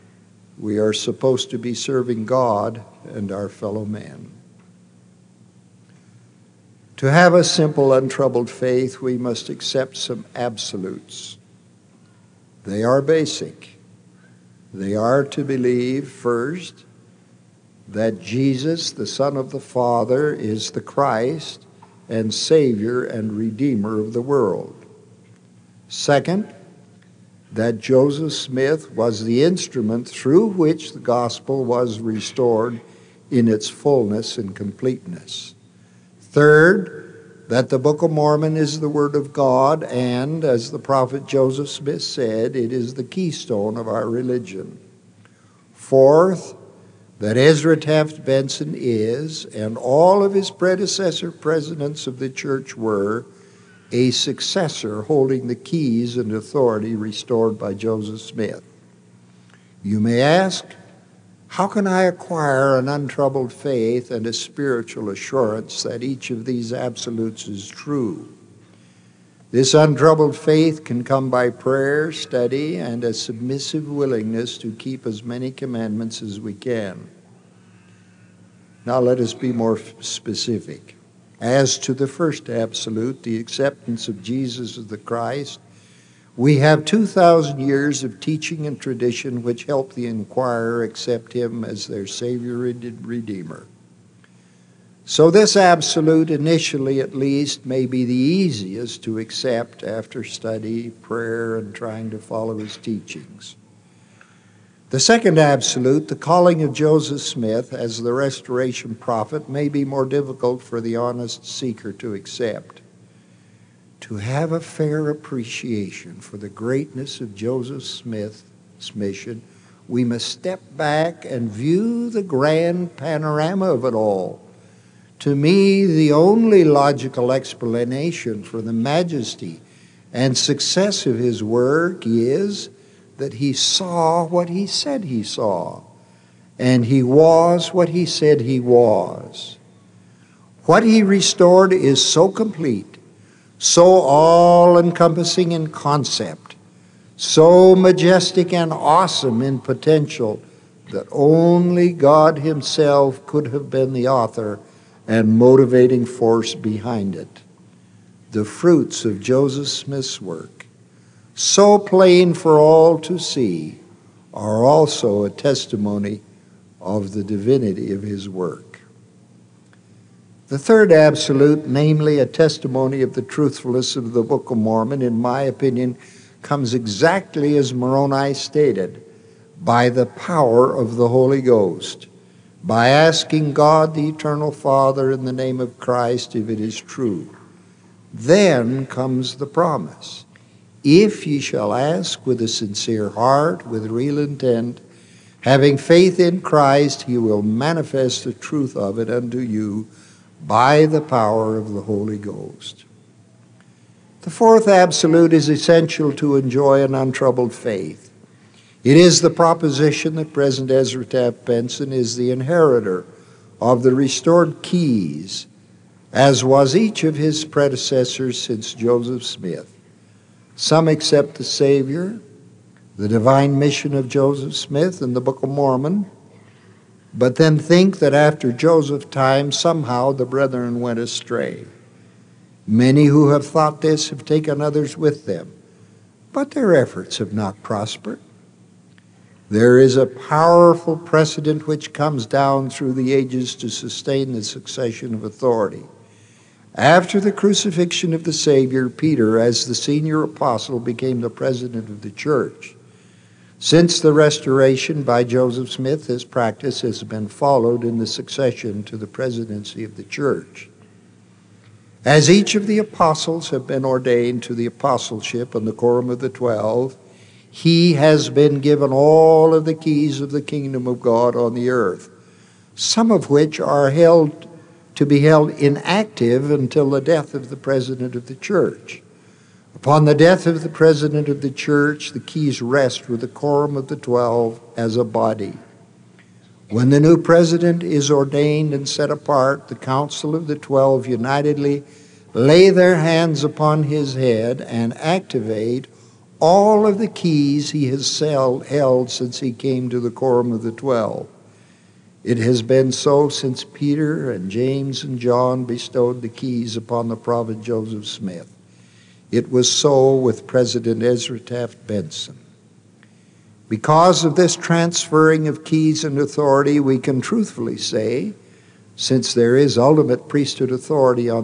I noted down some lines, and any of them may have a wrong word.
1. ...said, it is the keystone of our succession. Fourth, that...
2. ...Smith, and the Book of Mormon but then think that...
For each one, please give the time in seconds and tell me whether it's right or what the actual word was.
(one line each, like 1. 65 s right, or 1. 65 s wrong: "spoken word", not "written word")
1. 42 s wrong: "religion", not "succession"
2. 224 s right.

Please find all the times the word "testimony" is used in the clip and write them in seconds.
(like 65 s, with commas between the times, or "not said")
165 s, 172 s.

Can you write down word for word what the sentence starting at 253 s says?
Since the restoration by Joseph Smith, this practice has been followed in the succession to the presidency of the church.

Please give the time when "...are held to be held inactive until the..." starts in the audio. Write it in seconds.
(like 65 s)
273 s.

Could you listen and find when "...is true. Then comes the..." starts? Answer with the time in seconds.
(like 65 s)
186 s.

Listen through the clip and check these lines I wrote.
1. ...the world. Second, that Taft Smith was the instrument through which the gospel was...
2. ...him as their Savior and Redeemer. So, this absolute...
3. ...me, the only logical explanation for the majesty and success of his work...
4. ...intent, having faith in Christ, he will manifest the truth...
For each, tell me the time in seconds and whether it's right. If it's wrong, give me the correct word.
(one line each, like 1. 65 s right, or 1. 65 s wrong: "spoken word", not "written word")
1. 24 s wrong: "Joseph", not "Taft"
2. 91 s right
3. 125 s right
4. 194 s right.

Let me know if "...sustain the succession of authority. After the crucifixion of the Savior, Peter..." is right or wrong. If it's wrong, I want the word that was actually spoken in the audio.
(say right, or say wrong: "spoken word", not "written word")
right.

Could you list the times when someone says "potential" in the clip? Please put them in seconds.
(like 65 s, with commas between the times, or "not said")
149 s.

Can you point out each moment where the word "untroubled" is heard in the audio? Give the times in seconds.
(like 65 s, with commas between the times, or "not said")
7 s, 62 s, 69 s, 206 s.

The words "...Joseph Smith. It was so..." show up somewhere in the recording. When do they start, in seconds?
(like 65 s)
307 s.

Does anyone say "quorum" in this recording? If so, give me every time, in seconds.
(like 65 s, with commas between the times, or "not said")
265 s, 283 s, 300 s.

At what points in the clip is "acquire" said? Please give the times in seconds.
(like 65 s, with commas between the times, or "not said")
62 s.